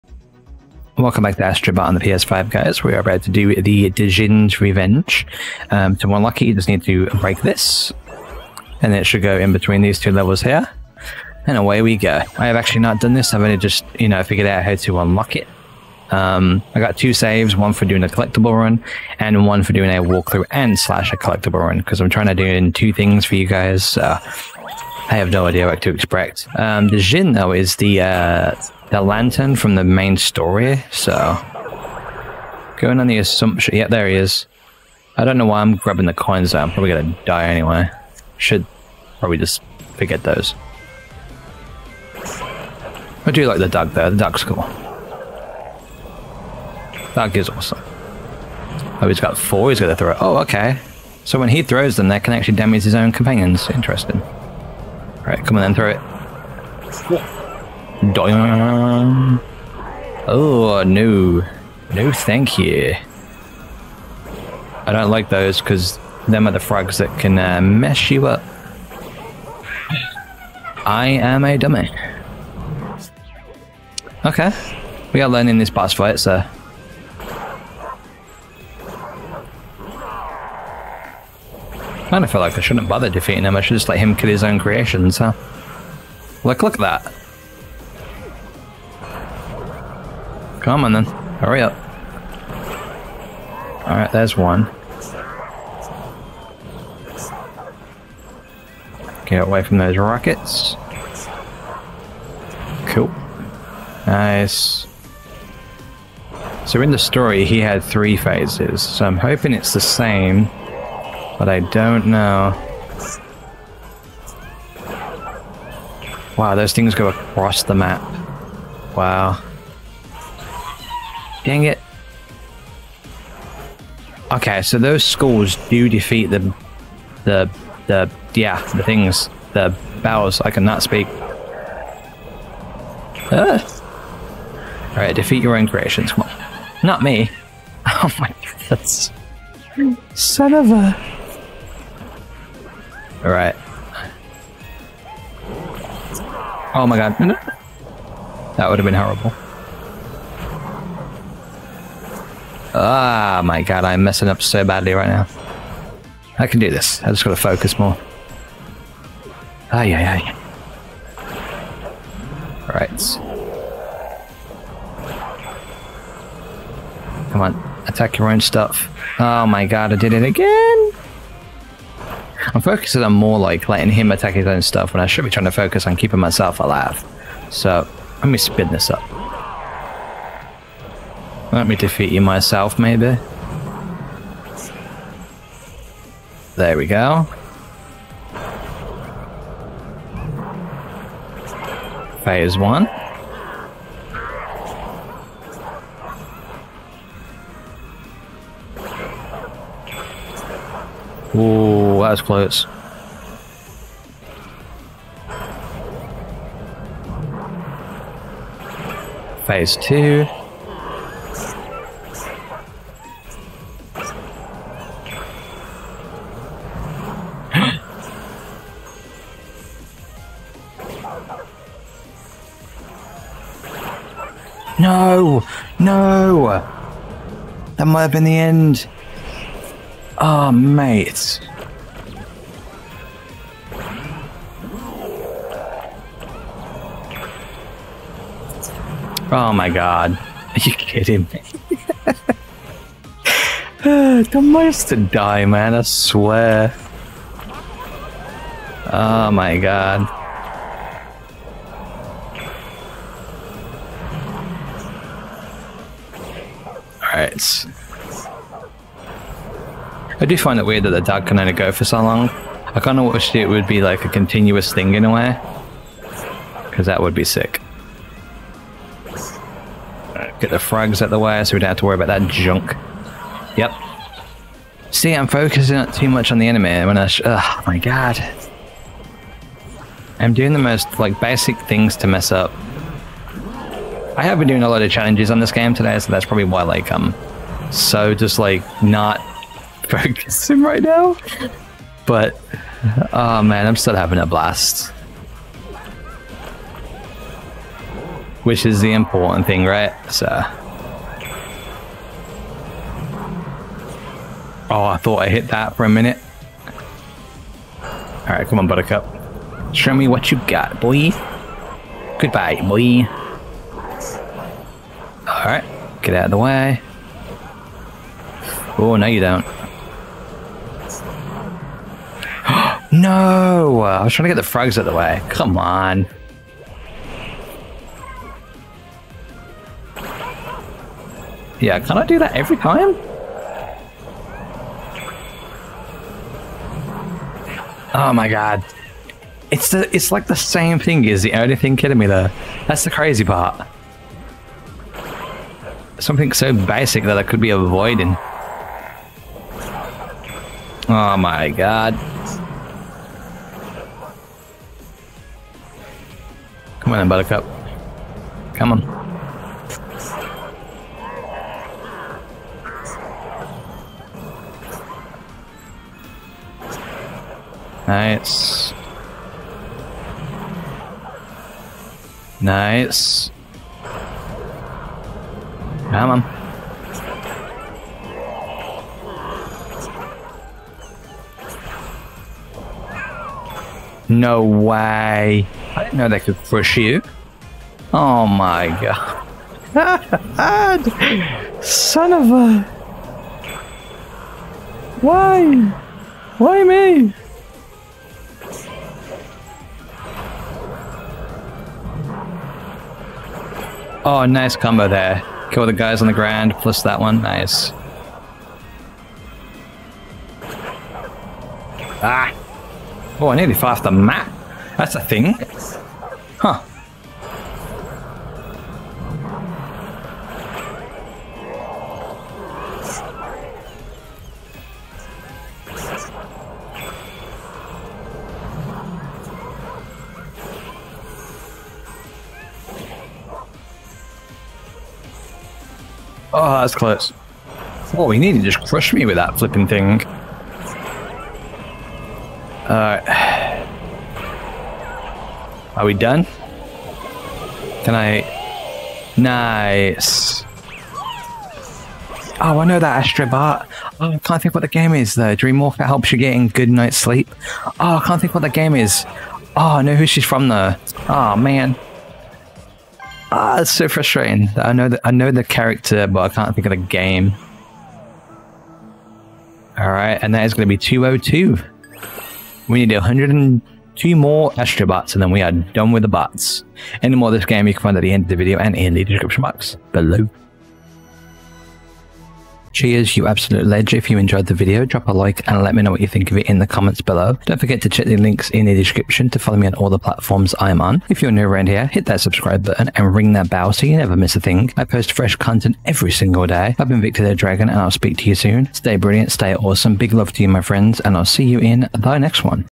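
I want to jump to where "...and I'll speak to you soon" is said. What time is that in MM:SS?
08:17.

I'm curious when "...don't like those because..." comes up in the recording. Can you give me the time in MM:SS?
01:04.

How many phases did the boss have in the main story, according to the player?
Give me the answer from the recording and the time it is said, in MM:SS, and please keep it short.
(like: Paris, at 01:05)
3, at 01:47.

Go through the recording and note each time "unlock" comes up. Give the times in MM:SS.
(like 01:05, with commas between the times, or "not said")
00:06, 00:14.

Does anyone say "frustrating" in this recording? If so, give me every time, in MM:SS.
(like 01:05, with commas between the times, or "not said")
07:43.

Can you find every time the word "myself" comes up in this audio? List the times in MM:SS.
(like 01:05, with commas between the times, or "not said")
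02:56, 03:02.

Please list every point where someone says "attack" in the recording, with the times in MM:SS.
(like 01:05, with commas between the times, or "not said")
02:47, 02:54.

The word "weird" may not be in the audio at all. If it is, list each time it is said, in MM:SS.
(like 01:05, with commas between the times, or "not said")
04:20.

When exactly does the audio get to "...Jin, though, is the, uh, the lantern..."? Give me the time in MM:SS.
00:26.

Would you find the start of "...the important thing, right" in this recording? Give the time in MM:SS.
04:58.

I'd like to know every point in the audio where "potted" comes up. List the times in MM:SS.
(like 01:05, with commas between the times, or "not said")
not said.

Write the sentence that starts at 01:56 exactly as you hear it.
Wow, those things go across the map.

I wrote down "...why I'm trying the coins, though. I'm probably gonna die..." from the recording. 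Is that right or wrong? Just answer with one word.
wrong.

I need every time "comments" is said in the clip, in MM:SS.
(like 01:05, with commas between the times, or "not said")
08:06.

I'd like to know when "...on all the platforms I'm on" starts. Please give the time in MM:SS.
08:09.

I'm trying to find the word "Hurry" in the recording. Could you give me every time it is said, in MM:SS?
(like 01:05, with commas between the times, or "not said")
01:31.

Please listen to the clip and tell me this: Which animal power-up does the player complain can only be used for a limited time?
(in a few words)
The dog.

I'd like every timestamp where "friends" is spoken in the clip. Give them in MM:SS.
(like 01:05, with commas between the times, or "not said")
08:20.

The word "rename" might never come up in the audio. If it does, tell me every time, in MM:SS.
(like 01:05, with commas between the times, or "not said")
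not said.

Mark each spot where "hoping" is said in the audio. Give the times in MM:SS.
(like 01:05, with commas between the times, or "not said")
01:49.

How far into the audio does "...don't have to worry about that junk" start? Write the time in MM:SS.
04:31.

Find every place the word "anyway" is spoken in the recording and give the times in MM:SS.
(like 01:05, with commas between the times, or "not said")
00:37.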